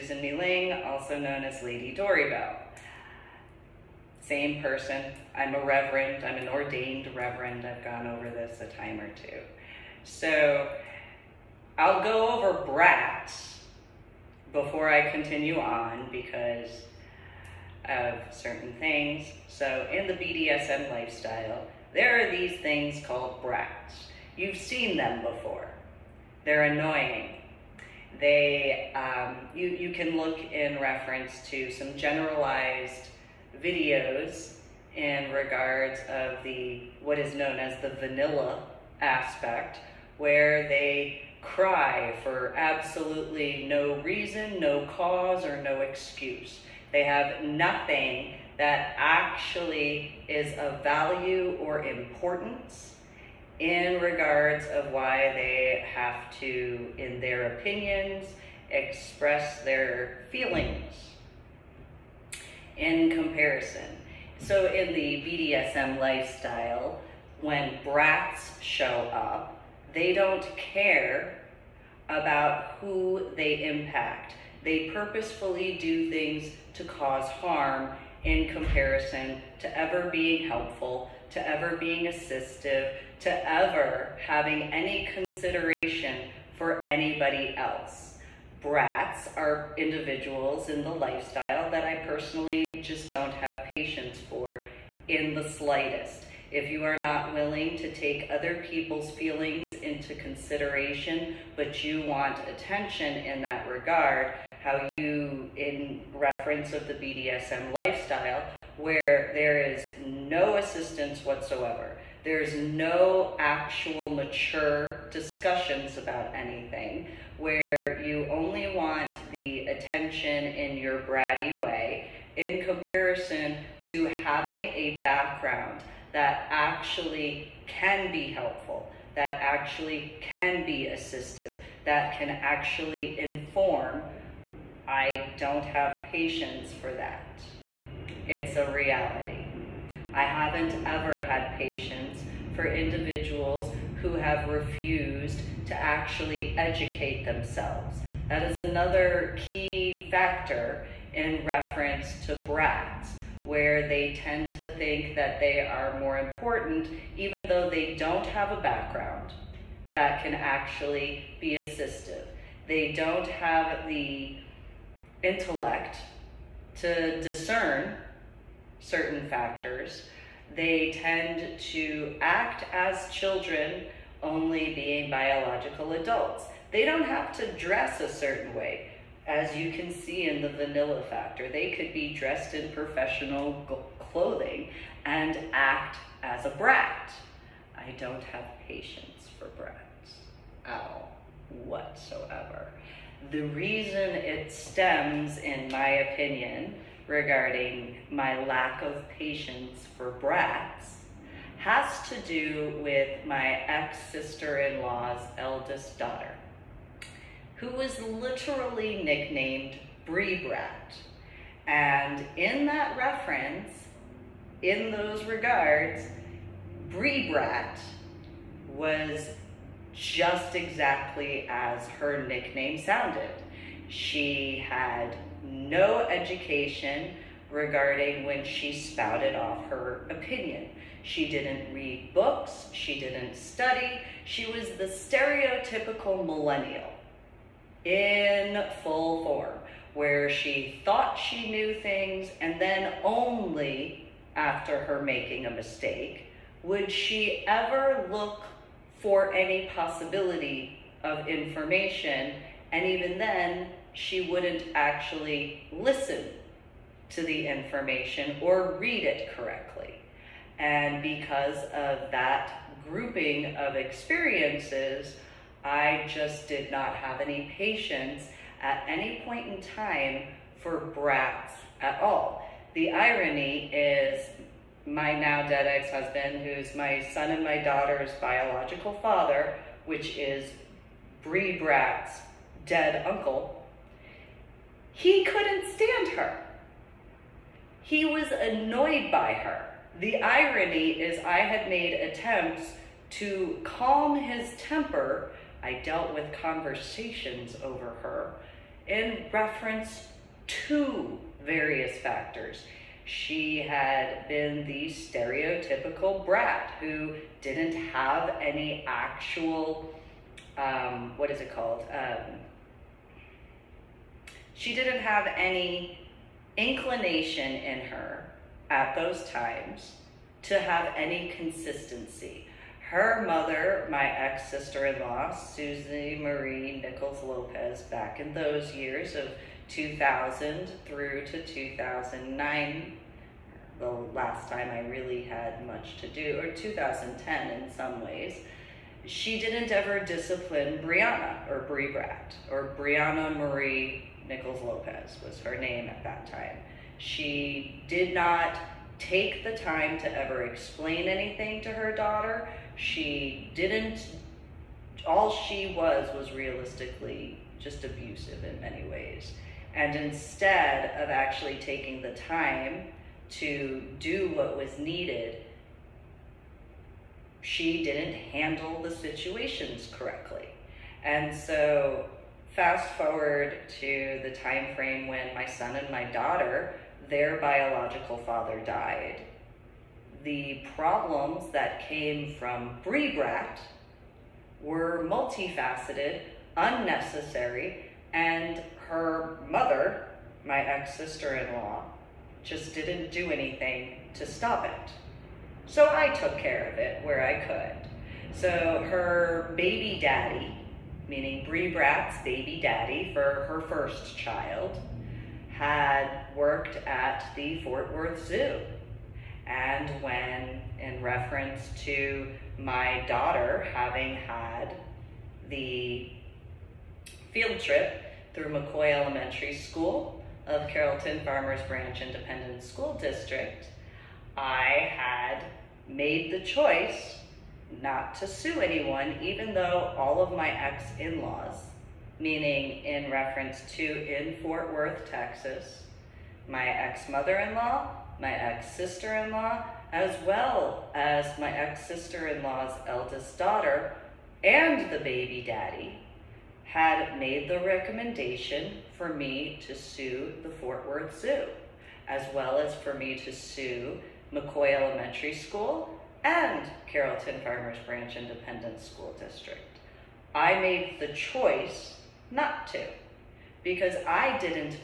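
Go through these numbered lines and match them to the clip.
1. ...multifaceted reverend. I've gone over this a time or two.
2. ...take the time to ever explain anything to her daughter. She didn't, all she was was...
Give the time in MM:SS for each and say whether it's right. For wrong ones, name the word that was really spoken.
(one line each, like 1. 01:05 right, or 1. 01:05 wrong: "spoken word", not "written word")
1. 00:06 wrong: "ordained", not "multifaceted"
2. 05:48 right.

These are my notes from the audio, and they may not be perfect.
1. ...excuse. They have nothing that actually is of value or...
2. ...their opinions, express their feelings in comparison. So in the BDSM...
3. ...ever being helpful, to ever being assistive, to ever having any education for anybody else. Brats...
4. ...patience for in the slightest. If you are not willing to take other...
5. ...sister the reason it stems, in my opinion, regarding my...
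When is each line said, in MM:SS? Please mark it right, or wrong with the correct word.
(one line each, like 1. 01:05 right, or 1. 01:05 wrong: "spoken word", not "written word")
1. 00:45 right
2. 00:57 right
3. 01:19 wrong: "consideration", not "education"
4. 01:33 right
5. 03:11 wrong: "whatsoever", not "sister".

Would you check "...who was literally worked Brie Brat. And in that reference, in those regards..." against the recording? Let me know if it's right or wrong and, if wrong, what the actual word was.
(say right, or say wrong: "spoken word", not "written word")
wrong: "nicknamed", not "worked".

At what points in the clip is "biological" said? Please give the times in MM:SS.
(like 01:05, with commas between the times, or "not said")
02:55, 04:38, 06:17.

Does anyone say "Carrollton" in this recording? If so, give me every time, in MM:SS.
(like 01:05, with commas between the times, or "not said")
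07:00, 07:36.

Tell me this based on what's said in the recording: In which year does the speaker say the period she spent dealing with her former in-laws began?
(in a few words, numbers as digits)
2000.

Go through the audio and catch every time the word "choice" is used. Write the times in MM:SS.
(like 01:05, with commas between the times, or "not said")
07:06, 07:41.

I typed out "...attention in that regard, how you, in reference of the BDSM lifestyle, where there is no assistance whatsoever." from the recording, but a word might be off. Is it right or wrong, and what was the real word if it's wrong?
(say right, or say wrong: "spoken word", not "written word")
right.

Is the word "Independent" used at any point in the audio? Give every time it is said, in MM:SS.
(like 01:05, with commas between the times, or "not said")
07:02, 07:38.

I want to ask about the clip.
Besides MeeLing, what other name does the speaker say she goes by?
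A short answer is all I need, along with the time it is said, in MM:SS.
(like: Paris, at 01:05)
Lady Dori Belle, at 00:01.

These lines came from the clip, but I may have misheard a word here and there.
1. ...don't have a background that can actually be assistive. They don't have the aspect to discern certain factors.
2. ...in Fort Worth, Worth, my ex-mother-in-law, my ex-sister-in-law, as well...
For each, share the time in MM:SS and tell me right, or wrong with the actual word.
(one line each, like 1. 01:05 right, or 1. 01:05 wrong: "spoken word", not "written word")
1. 02:37 wrong: "intellect", not "aspect"
2. 07:13 wrong: "Texas", not "Worth".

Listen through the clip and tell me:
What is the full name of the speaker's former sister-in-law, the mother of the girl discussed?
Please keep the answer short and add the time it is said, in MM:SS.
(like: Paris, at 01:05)
Susie Marie Nichols Lopez, at 05:25.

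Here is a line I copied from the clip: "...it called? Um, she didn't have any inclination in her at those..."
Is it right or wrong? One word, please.
right.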